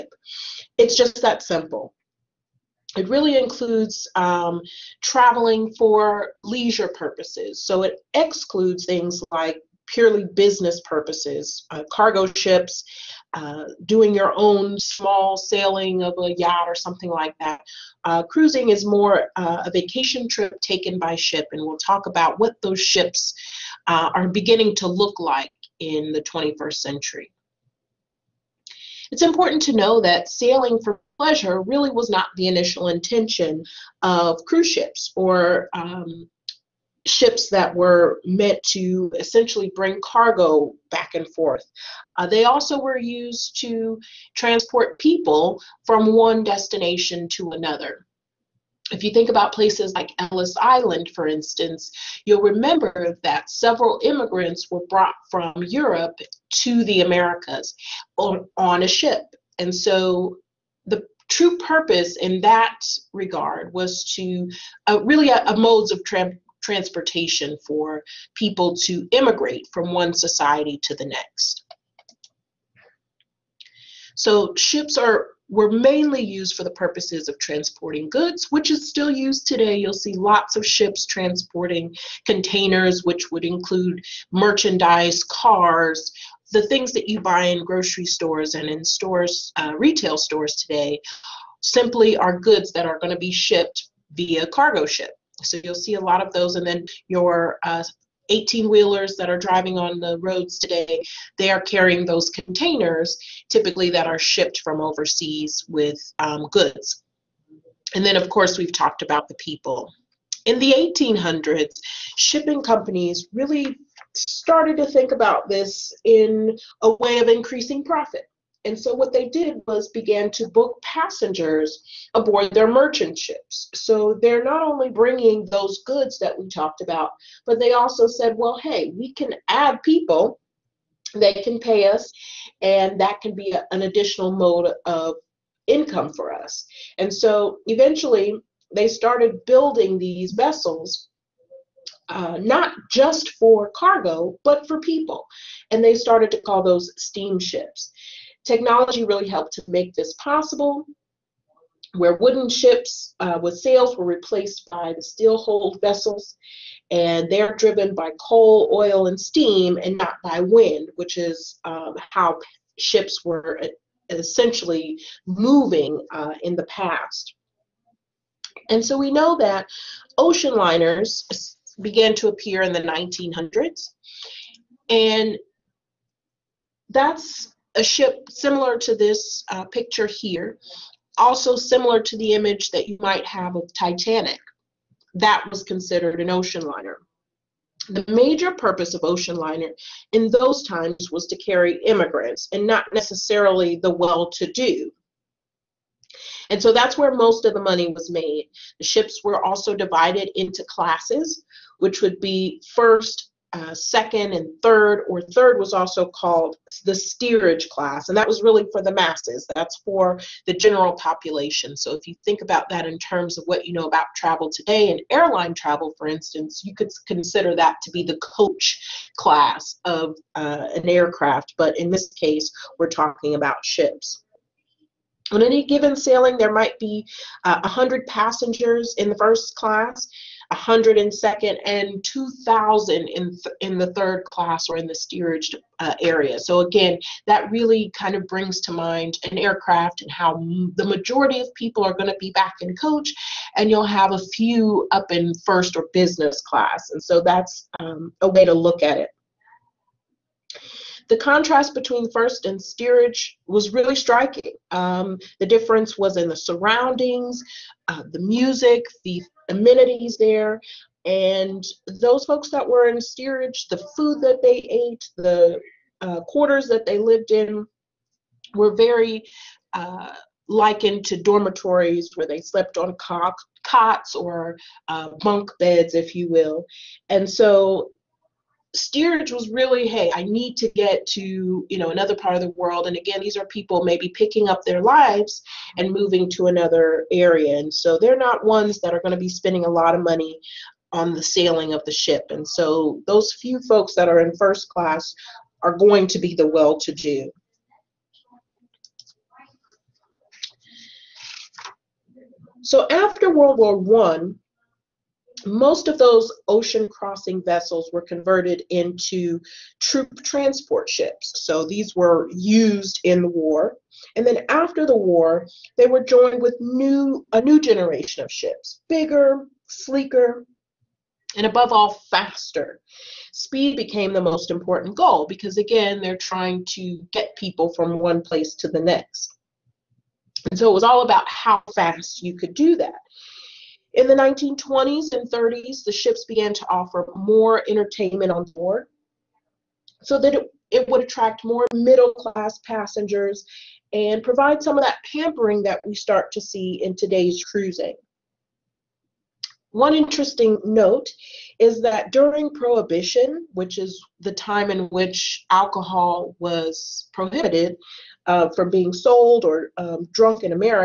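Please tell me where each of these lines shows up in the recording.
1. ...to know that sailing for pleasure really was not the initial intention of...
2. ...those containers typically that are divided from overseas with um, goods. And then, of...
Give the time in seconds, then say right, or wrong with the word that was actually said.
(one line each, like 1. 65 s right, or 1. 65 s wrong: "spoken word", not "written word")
1. 29 s right
2. 102 s wrong: "shipped", not "divided".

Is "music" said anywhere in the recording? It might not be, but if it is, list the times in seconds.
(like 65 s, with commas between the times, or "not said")
258 s.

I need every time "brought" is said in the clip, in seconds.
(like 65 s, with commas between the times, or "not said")
54 s.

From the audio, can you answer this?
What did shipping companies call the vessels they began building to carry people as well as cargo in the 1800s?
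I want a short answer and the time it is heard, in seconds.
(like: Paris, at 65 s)
steamships, at 146 s.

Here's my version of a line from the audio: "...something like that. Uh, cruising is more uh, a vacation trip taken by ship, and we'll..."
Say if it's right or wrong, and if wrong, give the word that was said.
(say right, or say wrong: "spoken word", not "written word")
right.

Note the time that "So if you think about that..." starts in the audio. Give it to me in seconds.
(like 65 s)
211 s.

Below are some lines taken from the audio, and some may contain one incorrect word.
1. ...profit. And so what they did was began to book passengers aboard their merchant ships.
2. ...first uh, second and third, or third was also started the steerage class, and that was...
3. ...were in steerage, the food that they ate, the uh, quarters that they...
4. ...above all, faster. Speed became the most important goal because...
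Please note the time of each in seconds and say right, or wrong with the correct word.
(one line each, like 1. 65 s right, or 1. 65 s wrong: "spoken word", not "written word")
1. 117 s right
2. 202 s wrong: "called", not "started"
3. 262 s right
4. 321 s right.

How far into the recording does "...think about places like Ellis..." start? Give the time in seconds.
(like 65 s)
49 s.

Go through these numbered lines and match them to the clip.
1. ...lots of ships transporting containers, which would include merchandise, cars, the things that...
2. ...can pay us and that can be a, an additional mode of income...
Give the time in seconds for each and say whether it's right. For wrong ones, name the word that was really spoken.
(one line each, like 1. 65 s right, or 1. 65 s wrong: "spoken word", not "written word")
1. 80 s right
2. 131 s right.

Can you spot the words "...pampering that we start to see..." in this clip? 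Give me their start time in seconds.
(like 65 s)
345 s.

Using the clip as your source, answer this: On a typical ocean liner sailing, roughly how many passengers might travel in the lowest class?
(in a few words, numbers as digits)
2,000.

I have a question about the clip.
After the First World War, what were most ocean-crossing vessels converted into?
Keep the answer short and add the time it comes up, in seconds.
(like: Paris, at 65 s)
troop transport ships, at 309 s.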